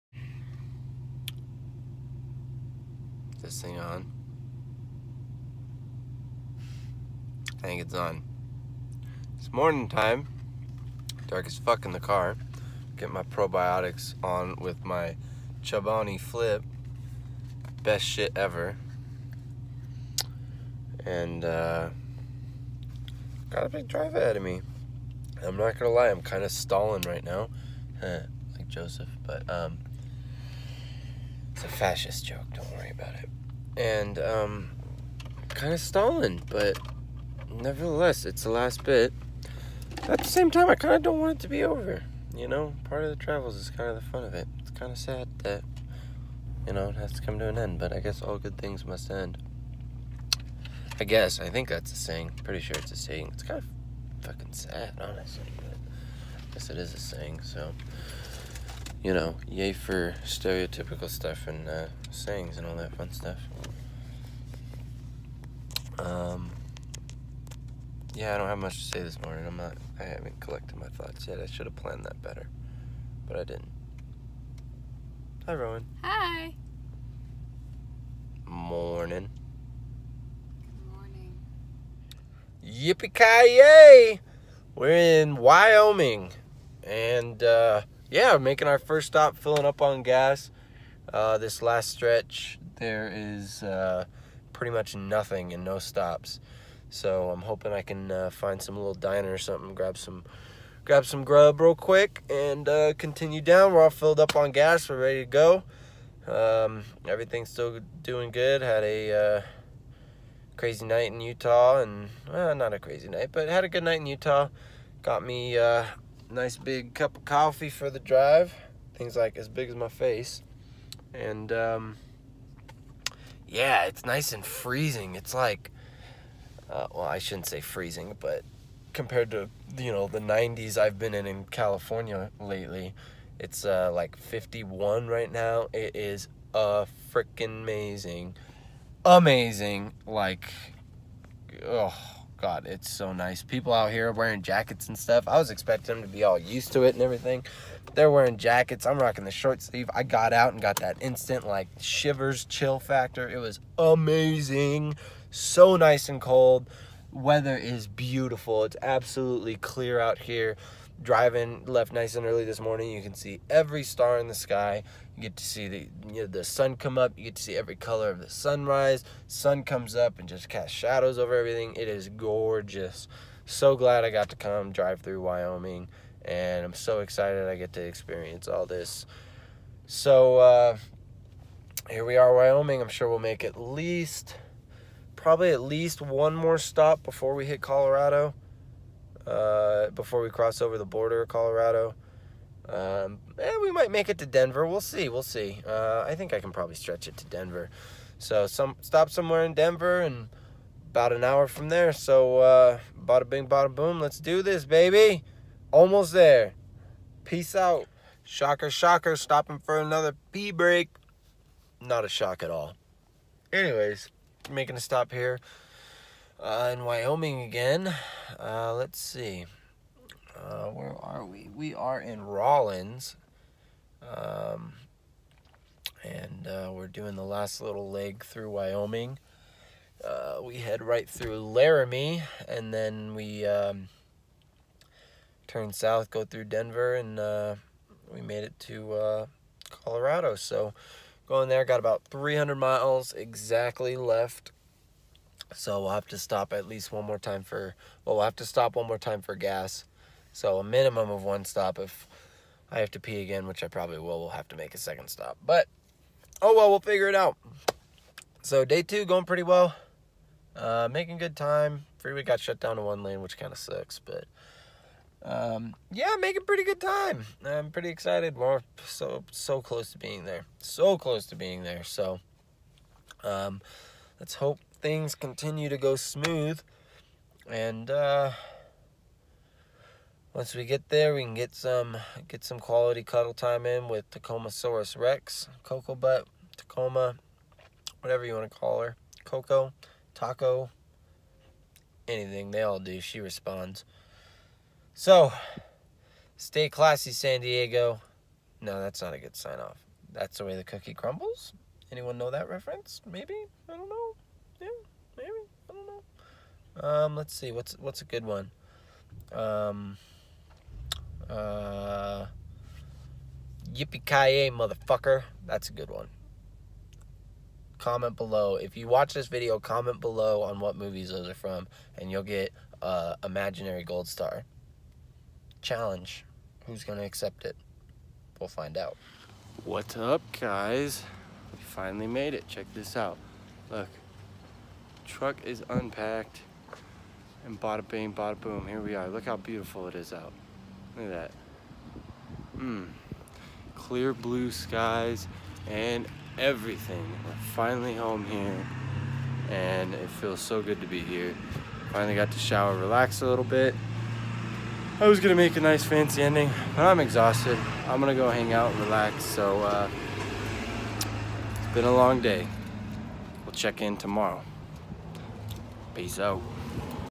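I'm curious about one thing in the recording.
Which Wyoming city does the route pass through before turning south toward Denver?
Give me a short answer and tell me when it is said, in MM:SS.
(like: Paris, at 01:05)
Laramie, at 03:51.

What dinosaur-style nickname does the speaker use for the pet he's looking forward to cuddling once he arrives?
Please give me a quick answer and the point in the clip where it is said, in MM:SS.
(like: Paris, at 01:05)
Tacomasaurus rex, at 04:44.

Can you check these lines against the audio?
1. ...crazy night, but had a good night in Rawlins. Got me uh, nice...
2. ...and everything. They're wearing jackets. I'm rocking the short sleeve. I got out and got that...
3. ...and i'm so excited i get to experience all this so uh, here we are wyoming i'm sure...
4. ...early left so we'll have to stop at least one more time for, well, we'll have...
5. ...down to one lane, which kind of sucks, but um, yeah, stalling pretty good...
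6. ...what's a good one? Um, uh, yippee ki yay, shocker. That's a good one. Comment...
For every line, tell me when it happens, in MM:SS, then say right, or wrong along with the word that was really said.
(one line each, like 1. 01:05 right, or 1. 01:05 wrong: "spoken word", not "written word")
1. 01:52 wrong: "Utah", not "Rawlins"
2. 02:26 right
3. 02:56 right
4. 04:03 wrong: "exactly", not "early"
5. 04:22 wrong: "making", not "stalling"
6. 05:07 wrong: "motherfucker", not "shocker".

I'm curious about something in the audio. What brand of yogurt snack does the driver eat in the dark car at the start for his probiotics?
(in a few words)
Chobani Flip.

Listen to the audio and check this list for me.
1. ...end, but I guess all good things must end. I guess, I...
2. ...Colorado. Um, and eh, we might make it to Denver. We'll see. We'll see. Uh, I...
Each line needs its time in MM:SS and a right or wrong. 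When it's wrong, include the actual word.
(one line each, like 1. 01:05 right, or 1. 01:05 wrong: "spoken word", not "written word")
1. 00:47 right
2. 03:11 right.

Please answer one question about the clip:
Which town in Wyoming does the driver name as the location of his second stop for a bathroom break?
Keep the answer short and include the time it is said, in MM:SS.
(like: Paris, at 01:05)
Rawlins, at 03:42.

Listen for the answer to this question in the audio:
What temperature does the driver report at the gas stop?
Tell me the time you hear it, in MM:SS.
02:14.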